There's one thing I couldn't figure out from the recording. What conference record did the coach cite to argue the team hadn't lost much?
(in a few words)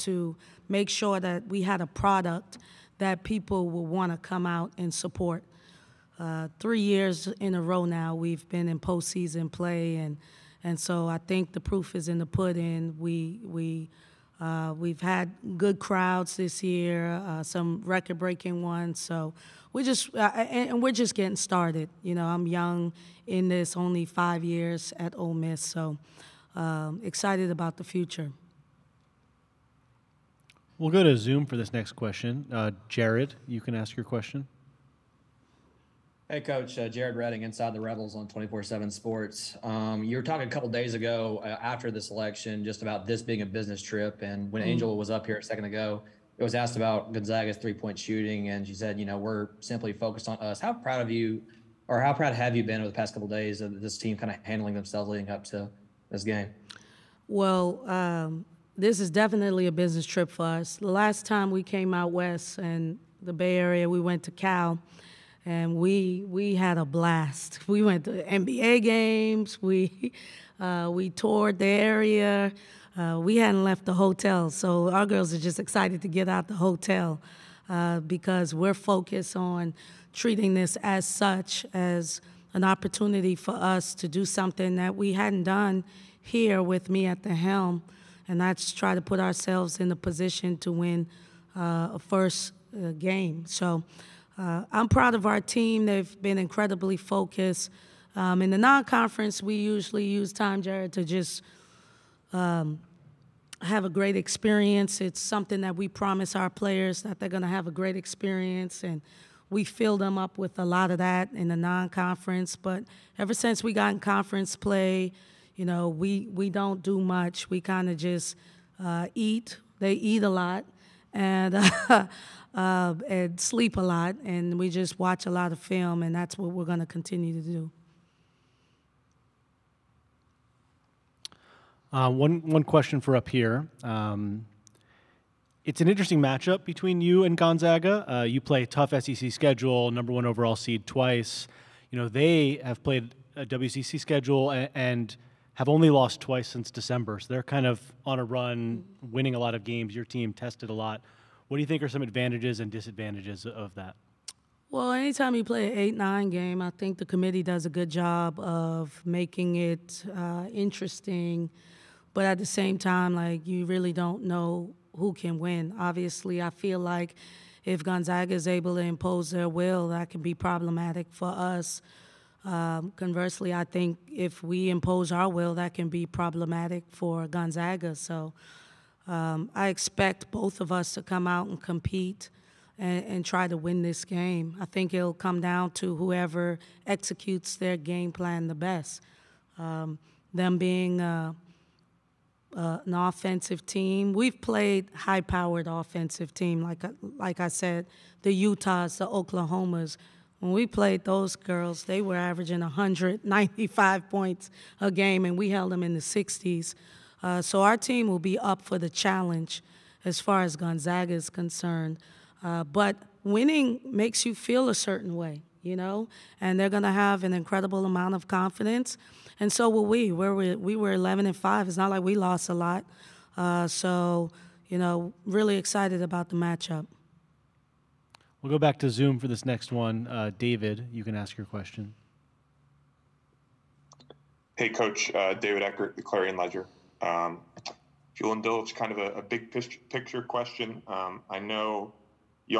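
11-5.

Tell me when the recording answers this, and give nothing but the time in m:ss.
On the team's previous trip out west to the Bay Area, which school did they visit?
1:04.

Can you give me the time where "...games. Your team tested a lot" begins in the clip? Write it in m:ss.
2:29.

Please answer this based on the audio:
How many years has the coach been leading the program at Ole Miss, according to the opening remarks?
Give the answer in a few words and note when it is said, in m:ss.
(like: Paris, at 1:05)
5, at 0:24.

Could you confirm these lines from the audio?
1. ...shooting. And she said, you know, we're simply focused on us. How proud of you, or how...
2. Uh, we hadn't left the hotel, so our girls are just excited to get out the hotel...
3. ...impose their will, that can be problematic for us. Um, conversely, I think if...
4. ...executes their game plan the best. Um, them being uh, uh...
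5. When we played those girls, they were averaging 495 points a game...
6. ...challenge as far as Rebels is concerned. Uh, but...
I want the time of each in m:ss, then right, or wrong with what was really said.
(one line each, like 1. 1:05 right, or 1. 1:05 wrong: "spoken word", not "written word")
1. 0:47 right
2. 1:12 right
3. 2:48 right
4. 3:06 right
5. 3:20 wrong: "195", not "495"
6. 3:28 wrong: "Gonzaga", not "Rebels".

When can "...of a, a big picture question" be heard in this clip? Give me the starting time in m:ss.
3:58.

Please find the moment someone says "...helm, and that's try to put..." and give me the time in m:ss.
1:27.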